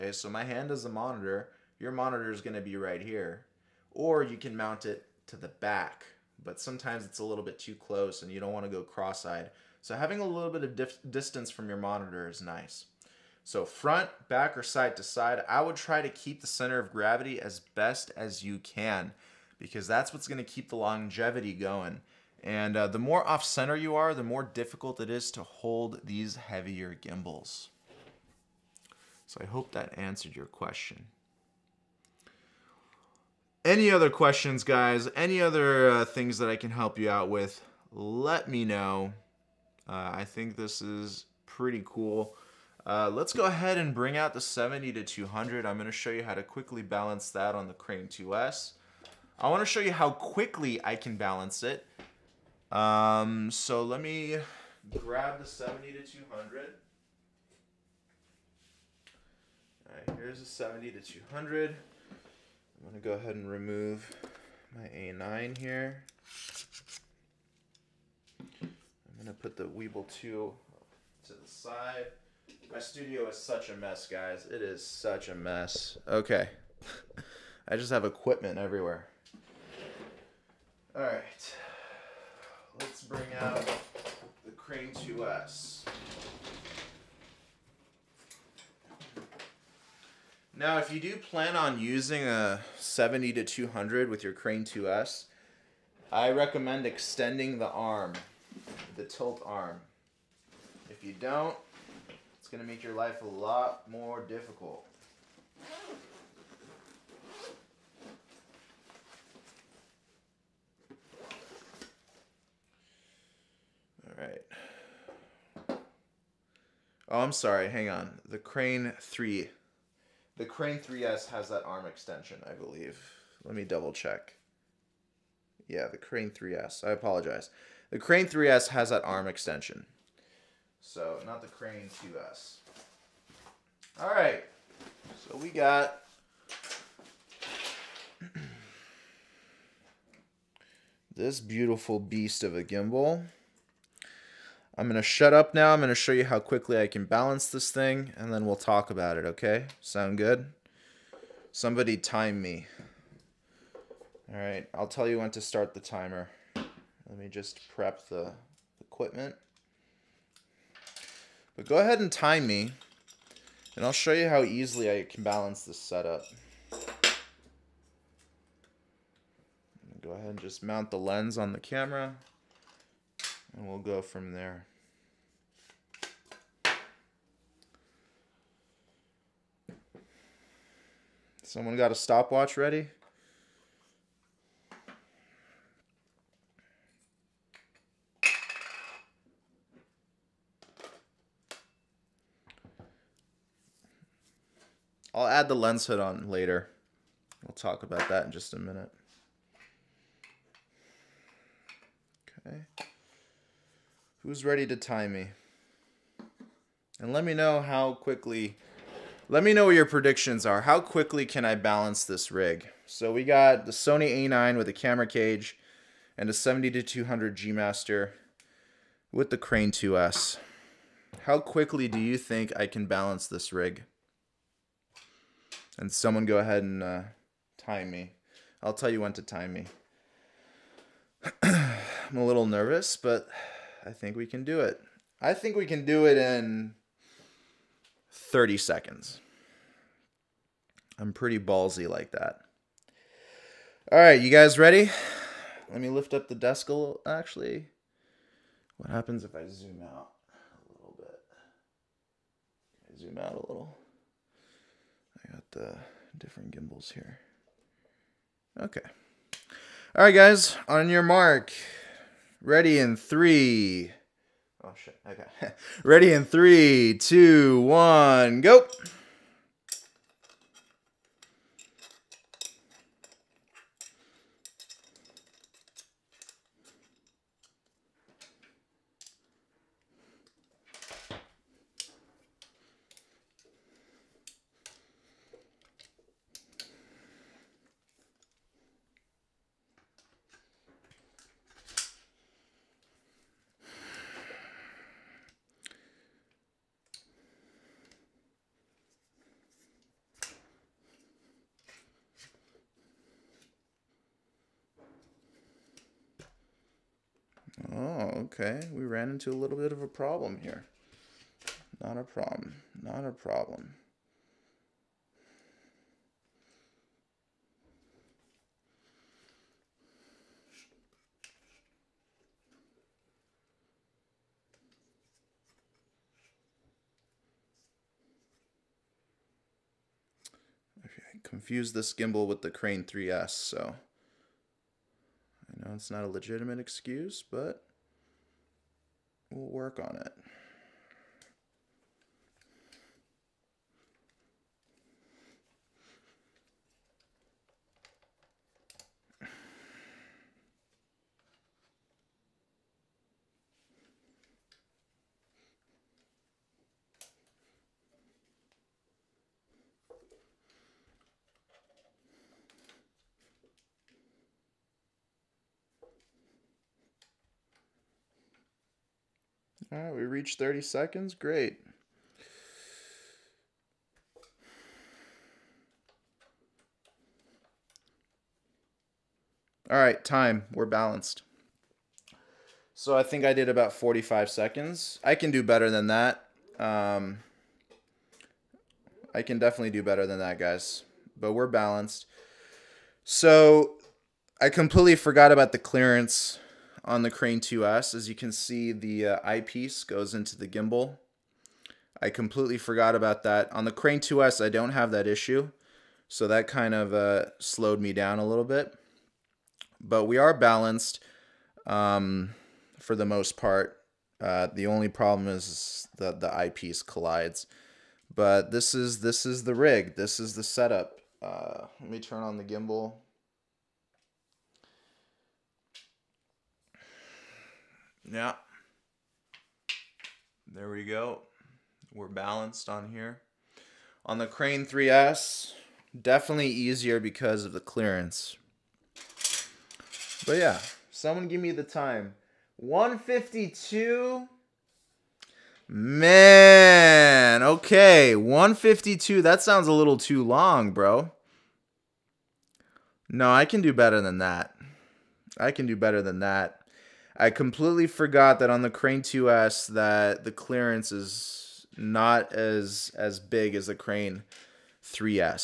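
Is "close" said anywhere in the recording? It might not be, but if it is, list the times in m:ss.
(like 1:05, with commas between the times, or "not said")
0:07.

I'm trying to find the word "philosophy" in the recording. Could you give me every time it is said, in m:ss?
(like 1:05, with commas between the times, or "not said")
not said.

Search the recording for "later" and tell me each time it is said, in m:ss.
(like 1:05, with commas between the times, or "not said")
3:16.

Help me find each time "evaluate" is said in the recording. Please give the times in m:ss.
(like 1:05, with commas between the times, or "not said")
not said.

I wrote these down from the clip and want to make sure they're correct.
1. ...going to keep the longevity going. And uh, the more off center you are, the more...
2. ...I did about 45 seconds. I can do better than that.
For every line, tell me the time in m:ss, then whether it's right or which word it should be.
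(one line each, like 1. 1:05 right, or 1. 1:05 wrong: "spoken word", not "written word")
1. 0:20 right
2. 6:23 right.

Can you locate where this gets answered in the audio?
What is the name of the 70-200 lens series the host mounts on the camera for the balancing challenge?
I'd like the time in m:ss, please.
3:37.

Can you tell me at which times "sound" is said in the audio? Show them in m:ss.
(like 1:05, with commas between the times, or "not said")
2:29, 7:29.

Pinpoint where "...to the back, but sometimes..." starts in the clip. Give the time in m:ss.
0:05.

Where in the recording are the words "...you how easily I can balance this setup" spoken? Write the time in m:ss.
2:44.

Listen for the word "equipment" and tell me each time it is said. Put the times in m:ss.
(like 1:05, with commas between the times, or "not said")
1:18, 2:38.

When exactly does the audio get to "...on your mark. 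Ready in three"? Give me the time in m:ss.
4:20.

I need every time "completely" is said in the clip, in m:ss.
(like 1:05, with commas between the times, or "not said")
6:34, 6:42, 7:37.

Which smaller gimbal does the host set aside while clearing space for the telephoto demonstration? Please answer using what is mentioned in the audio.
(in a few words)
Weebill 2.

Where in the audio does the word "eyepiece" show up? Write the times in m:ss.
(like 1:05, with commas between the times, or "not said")
6:39, 6:56.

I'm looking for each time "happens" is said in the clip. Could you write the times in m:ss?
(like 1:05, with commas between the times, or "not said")
4:08.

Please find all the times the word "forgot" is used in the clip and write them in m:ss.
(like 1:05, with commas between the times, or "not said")
6:34, 6:42, 7:37.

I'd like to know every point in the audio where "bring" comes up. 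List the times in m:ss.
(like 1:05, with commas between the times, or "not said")
0:43, 1:23.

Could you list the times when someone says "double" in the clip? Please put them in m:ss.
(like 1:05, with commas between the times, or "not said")
2:03.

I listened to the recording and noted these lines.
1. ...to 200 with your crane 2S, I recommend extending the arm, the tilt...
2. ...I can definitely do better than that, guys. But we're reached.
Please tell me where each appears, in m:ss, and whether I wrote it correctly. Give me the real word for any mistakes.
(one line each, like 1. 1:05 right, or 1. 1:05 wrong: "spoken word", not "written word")
1. 1:33 right
2. 6:29 wrong: "balanced", not "reached".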